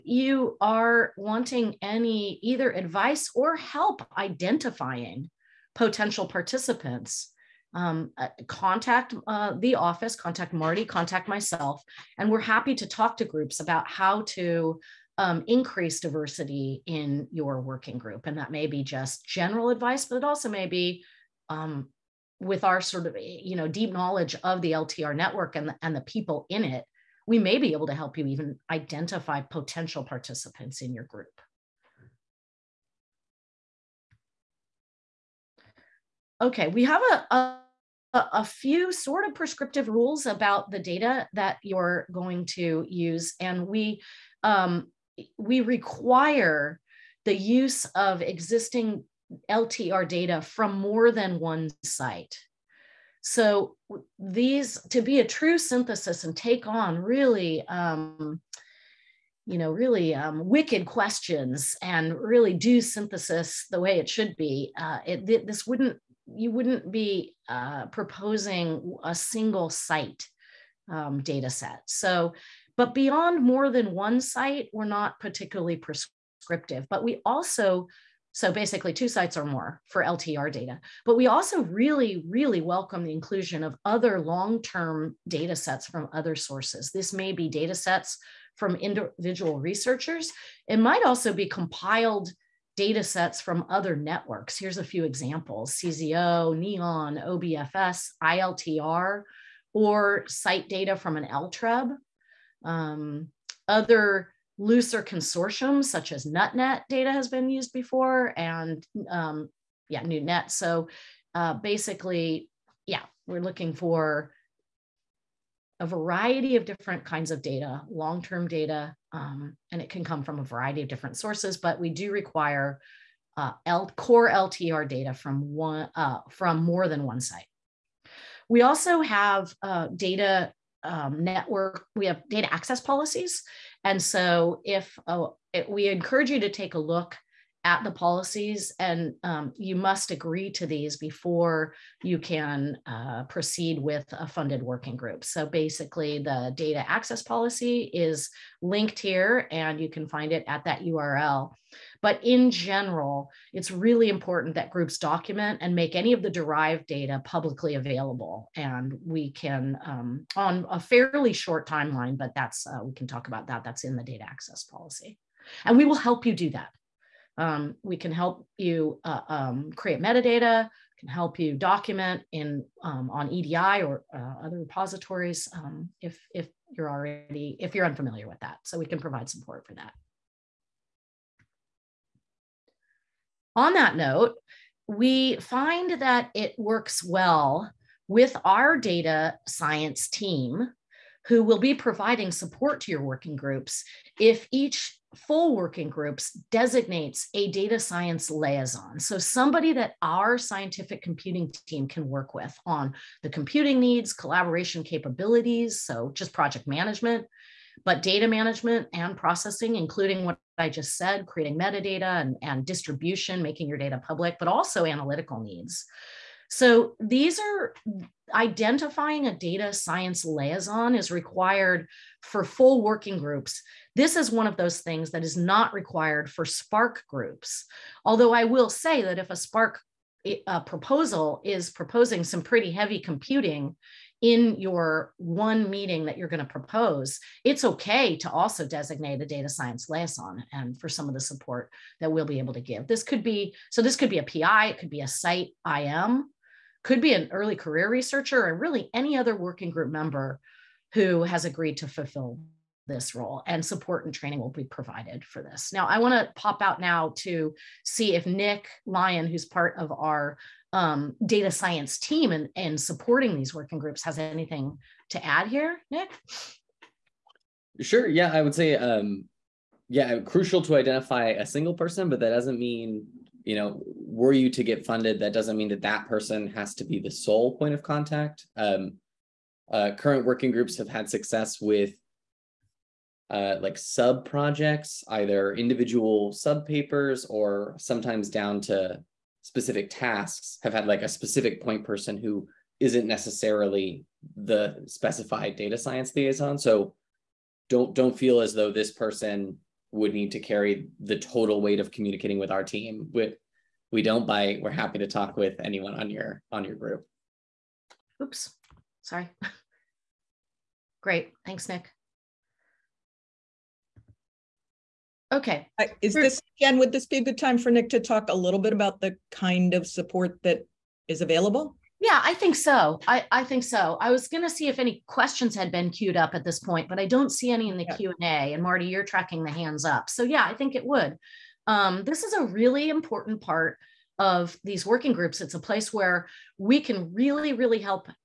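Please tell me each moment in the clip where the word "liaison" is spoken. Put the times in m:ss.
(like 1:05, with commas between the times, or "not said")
3:18, 3:40, 3:59, 4:56.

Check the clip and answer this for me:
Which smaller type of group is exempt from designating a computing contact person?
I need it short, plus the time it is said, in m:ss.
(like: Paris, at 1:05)
SPARC groups, at 3:46.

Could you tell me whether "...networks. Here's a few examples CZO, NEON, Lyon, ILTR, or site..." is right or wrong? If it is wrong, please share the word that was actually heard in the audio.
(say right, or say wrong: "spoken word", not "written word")
wrong: "OBFS", not "Lyon".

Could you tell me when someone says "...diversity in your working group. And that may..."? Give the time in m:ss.
0:15.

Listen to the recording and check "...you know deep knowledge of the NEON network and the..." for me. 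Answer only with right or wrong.
wrong.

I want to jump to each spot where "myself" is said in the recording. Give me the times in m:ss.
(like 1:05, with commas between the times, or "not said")
0:11.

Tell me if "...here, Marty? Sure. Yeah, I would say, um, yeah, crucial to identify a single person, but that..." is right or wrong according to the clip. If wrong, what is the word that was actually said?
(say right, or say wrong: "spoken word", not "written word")
wrong: "Nick", not "Marty".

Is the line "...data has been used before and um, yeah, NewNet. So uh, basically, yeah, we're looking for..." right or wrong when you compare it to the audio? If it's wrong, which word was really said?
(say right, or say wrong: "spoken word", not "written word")
right.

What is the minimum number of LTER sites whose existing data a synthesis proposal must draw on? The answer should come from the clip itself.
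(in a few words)
2.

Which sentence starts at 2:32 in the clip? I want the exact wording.
But in general, it's really important that groups document and make any of the derived data publicly available.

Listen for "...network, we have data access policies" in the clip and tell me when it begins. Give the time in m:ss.
2:11.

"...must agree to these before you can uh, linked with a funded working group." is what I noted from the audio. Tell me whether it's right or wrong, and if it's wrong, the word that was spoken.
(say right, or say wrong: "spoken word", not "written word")
wrong: "proceed", not "linked".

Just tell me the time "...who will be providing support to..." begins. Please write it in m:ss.
3:11.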